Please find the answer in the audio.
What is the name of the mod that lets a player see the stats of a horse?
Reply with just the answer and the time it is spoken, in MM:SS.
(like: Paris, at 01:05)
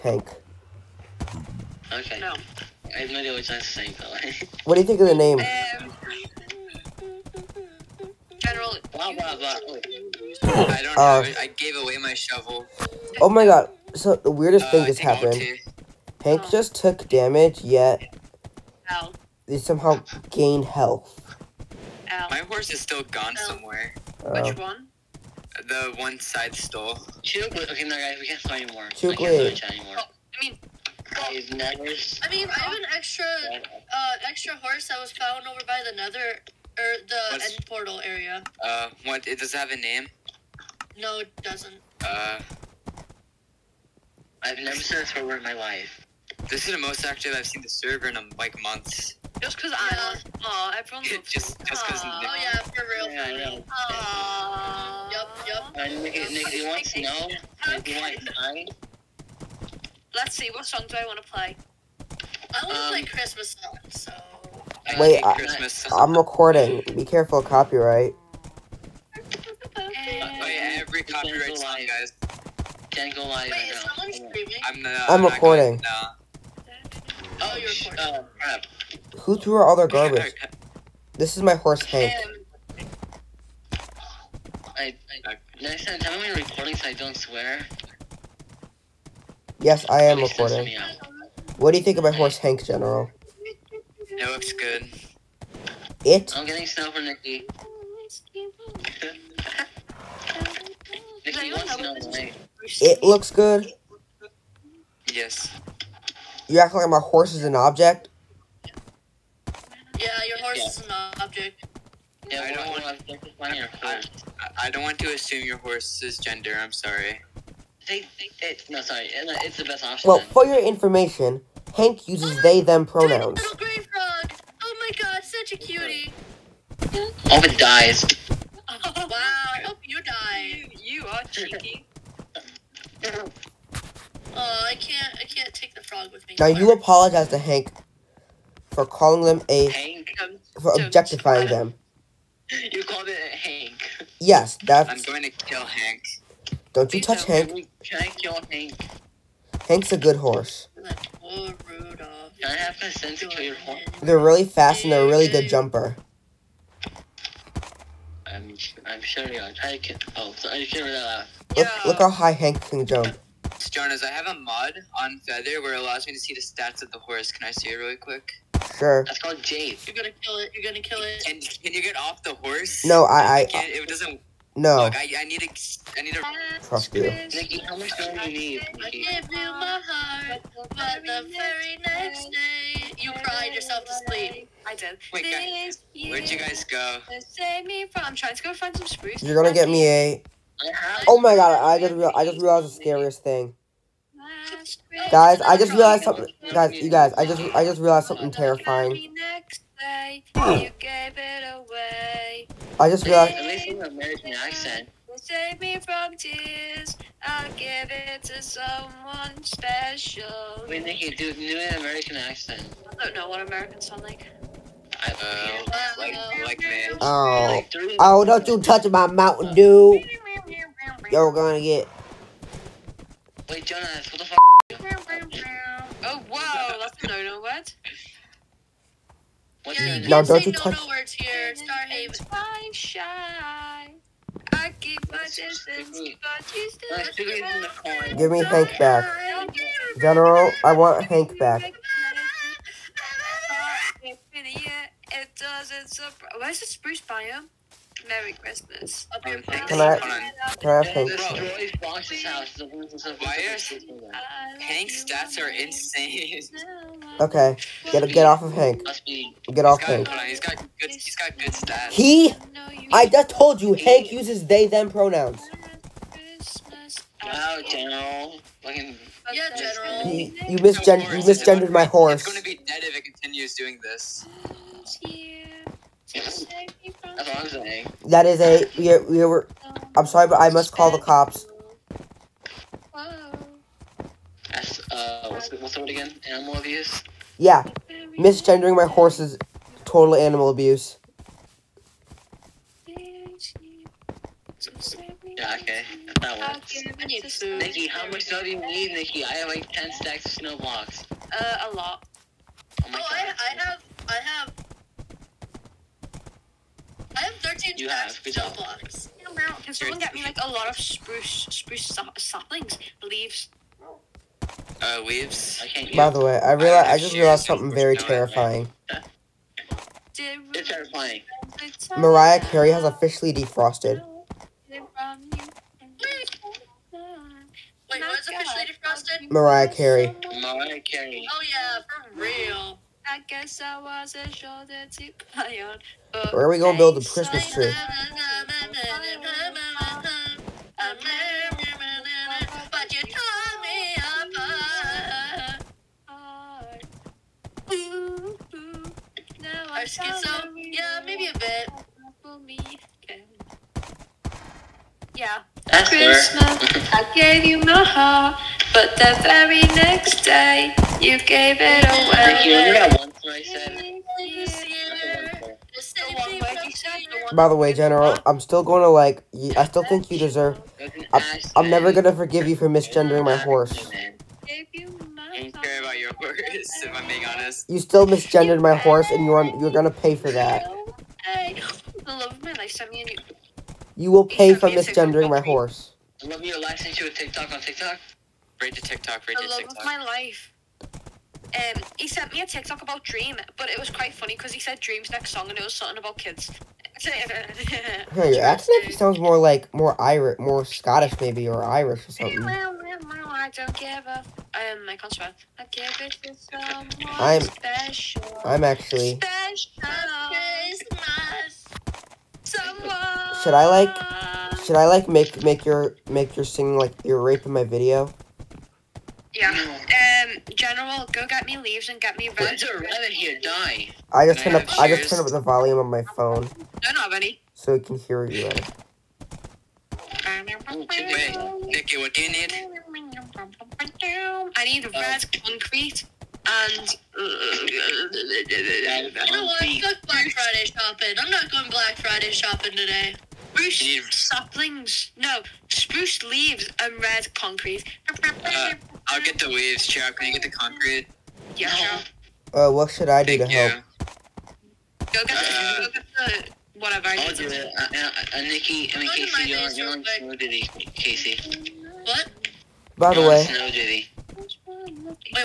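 Jade, at 02:49.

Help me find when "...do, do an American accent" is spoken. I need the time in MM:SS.
03:31.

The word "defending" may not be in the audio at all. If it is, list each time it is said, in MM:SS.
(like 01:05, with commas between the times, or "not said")
not said.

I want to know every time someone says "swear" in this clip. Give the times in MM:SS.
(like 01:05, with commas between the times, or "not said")
01:27, 06:45.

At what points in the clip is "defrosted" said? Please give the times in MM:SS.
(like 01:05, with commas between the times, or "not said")
05:23, 05:28.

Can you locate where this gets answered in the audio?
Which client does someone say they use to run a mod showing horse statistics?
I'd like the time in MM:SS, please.
02:45.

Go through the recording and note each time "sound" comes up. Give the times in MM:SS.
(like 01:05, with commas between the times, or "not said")
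03:33, 06:38.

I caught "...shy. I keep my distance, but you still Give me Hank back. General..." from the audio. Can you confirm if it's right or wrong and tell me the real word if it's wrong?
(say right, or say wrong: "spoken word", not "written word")
right.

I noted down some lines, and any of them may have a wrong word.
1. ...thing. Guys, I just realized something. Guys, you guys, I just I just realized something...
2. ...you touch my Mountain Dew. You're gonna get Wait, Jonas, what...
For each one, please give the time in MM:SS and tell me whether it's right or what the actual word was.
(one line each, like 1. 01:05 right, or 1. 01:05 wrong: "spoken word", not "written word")
1. 03:13 right
2. 03:38 right.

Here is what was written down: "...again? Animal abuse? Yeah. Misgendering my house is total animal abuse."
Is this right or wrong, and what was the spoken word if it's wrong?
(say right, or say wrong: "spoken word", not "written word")
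wrong: "horse", not "house".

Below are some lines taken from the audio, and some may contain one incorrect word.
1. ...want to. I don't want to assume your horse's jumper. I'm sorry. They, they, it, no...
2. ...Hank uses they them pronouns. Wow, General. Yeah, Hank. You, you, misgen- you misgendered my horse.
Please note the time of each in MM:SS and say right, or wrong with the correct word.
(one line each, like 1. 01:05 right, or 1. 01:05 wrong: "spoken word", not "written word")
1. 01:53 wrong: "gender", not "jumper"
2. 04:23 wrong: "General", not "Hank".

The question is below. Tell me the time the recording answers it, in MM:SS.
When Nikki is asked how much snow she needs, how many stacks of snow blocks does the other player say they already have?
04:59.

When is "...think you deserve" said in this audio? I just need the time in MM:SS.
06:09.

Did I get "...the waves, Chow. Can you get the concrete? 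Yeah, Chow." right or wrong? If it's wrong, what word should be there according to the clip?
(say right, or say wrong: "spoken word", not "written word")
right.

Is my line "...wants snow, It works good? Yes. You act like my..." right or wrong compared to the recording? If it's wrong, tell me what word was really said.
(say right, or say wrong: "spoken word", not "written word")
wrong: "looks", not "works".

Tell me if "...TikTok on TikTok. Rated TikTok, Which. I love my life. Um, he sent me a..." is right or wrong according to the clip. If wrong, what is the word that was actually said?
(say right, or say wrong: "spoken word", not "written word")
wrong: "TikTok", not "Which".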